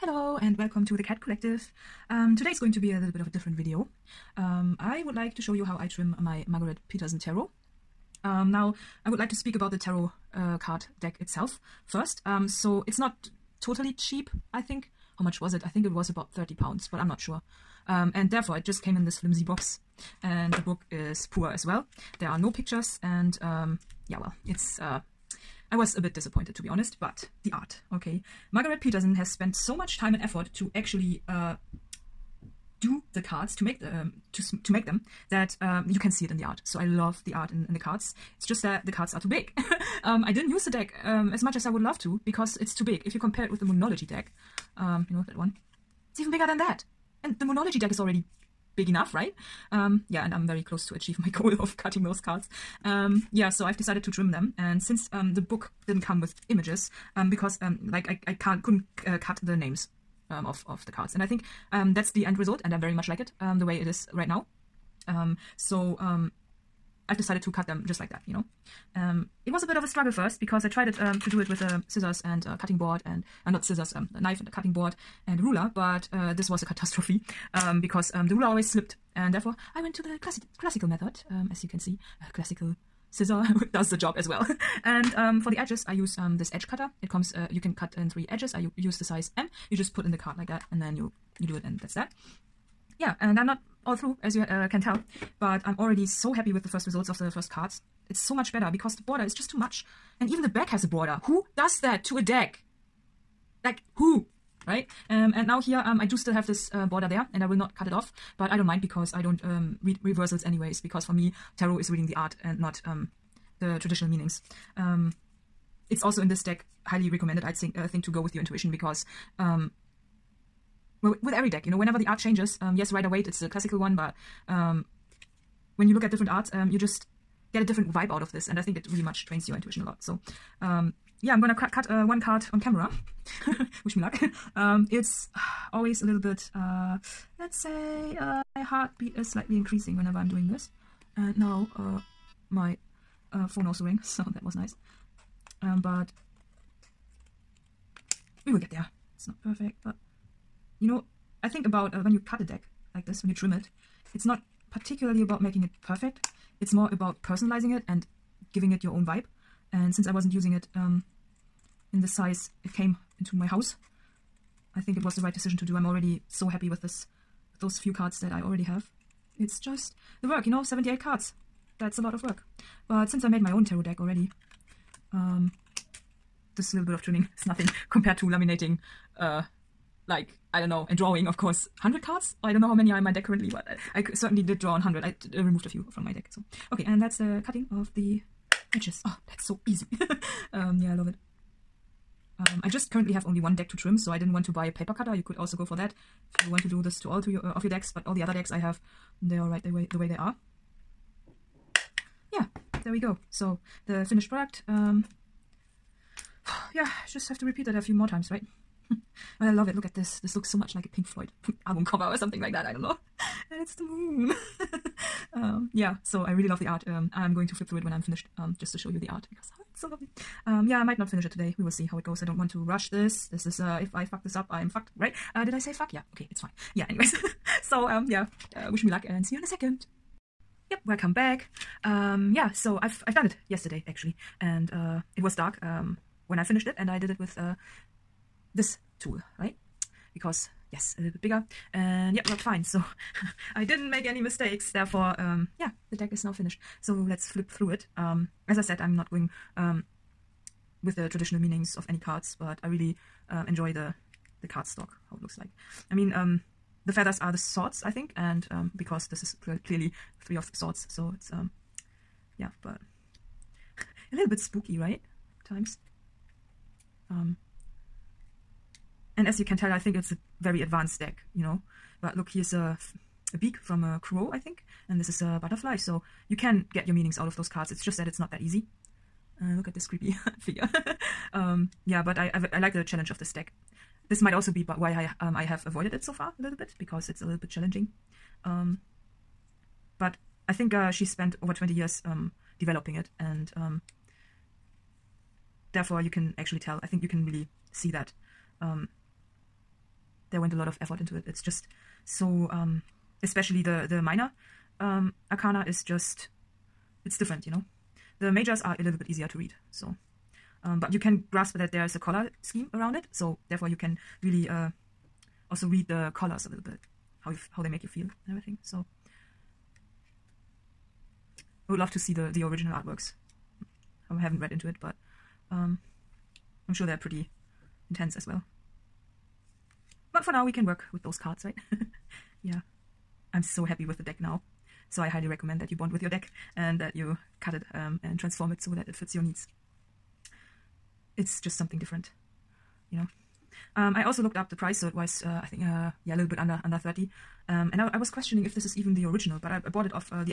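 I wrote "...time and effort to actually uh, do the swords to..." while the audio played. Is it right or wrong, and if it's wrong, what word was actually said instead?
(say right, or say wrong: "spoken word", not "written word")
wrong: "cards", not "swords".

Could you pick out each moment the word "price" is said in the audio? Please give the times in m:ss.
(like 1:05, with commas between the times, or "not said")
5:44.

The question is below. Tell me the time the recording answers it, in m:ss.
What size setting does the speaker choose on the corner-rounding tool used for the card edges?
1:29.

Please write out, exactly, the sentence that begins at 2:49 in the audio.
It's just the work, you know, 78 cards.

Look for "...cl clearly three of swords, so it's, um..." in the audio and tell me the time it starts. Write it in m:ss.
4:19.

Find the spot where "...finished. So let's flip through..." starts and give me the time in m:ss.
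4:06.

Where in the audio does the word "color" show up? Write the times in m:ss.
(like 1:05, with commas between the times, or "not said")
5:11, 5:16.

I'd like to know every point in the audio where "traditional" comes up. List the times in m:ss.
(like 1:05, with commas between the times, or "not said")
1:53, 4:11.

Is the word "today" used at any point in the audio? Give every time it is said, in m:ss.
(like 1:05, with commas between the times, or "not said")
0:02, 3:41.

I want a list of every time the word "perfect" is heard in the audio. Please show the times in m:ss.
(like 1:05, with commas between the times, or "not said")
2:29, 2:35.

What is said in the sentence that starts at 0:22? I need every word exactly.
There are no pictures and um, yeah, well, it's...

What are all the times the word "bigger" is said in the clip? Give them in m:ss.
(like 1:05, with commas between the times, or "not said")
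0:46, 4:01.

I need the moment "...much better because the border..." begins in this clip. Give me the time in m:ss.
1:38.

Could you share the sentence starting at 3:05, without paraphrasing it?
I uh, removed a few from my deck.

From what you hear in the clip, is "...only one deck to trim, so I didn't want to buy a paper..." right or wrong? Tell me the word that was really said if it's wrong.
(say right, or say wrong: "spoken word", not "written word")
right.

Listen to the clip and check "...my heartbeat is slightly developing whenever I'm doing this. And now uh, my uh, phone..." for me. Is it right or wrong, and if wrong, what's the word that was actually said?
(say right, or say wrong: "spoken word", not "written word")
wrong: "increasing", not "developing".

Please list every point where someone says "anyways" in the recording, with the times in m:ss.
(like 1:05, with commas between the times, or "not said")
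1:50, 3:46.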